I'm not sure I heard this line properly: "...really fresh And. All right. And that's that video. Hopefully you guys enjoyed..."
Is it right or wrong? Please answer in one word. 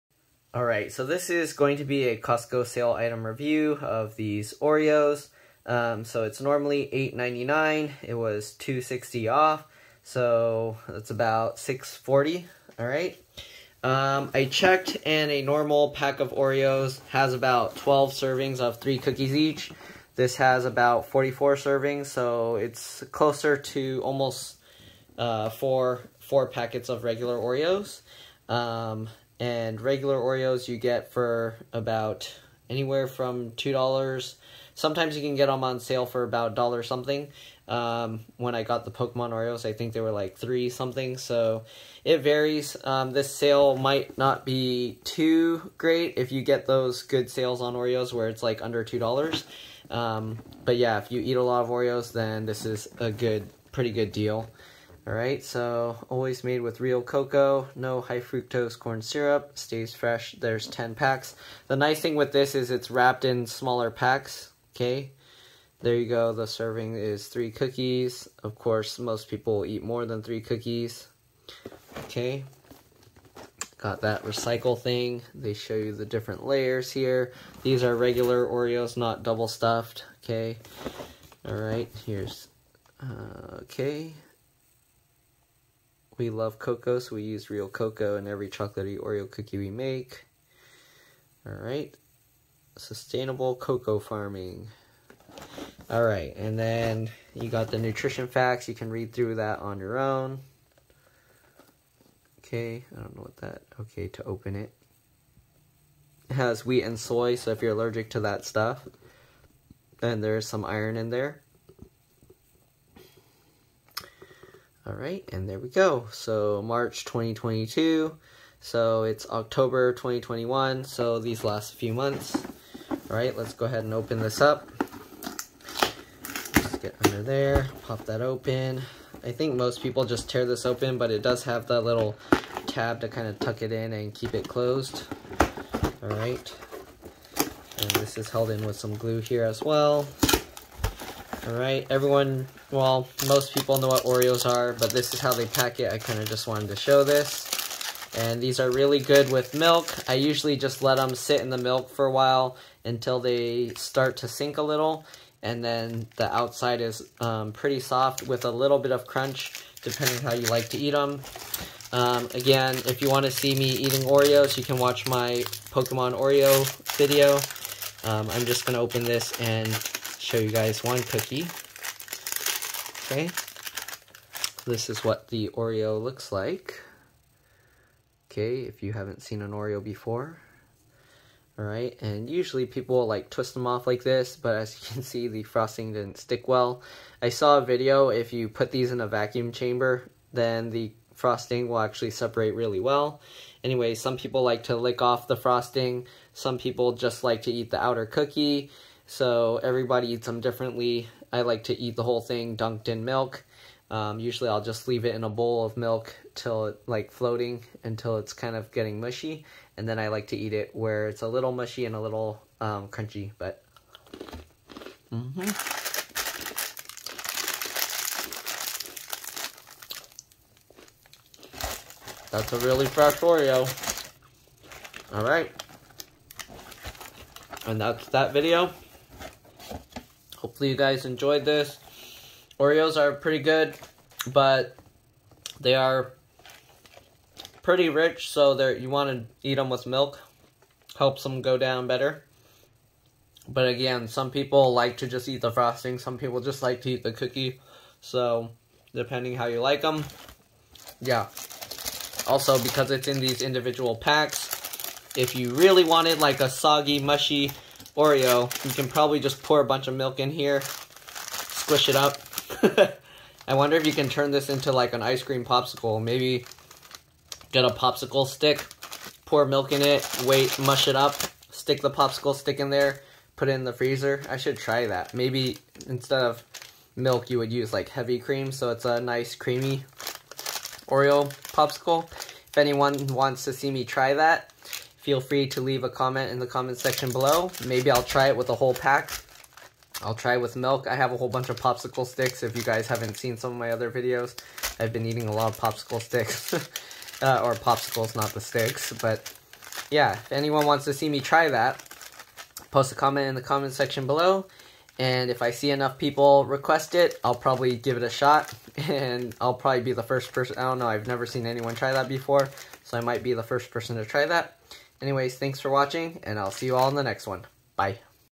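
wrong.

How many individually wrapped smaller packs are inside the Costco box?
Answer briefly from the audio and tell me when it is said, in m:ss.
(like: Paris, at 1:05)
10, at 1:00.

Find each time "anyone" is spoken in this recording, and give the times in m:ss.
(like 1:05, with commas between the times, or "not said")
4:42, 5:00, 5:11.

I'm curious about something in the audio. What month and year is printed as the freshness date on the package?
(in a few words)
March 2022.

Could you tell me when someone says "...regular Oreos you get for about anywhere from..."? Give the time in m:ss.
0:29.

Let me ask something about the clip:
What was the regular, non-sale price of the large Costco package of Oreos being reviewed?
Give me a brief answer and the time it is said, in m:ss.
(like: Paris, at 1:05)
$8.99, at 0:06.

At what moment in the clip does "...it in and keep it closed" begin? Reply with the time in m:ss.
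2:13.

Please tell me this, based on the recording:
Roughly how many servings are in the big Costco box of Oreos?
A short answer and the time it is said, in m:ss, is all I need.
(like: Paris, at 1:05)
44, at 0:21.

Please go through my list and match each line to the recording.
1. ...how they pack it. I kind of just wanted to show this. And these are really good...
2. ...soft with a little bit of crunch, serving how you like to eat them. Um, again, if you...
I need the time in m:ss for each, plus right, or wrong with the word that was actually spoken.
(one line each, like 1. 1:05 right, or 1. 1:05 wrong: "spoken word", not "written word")
1. 2:25 right
2. 2:37 wrong: "depending", not "serving".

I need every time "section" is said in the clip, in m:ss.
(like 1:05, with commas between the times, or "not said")
4:46, 5:03.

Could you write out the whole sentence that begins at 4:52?
If you guys haven't seen some of my other videos, I've been eating a lot of popsicle sticks.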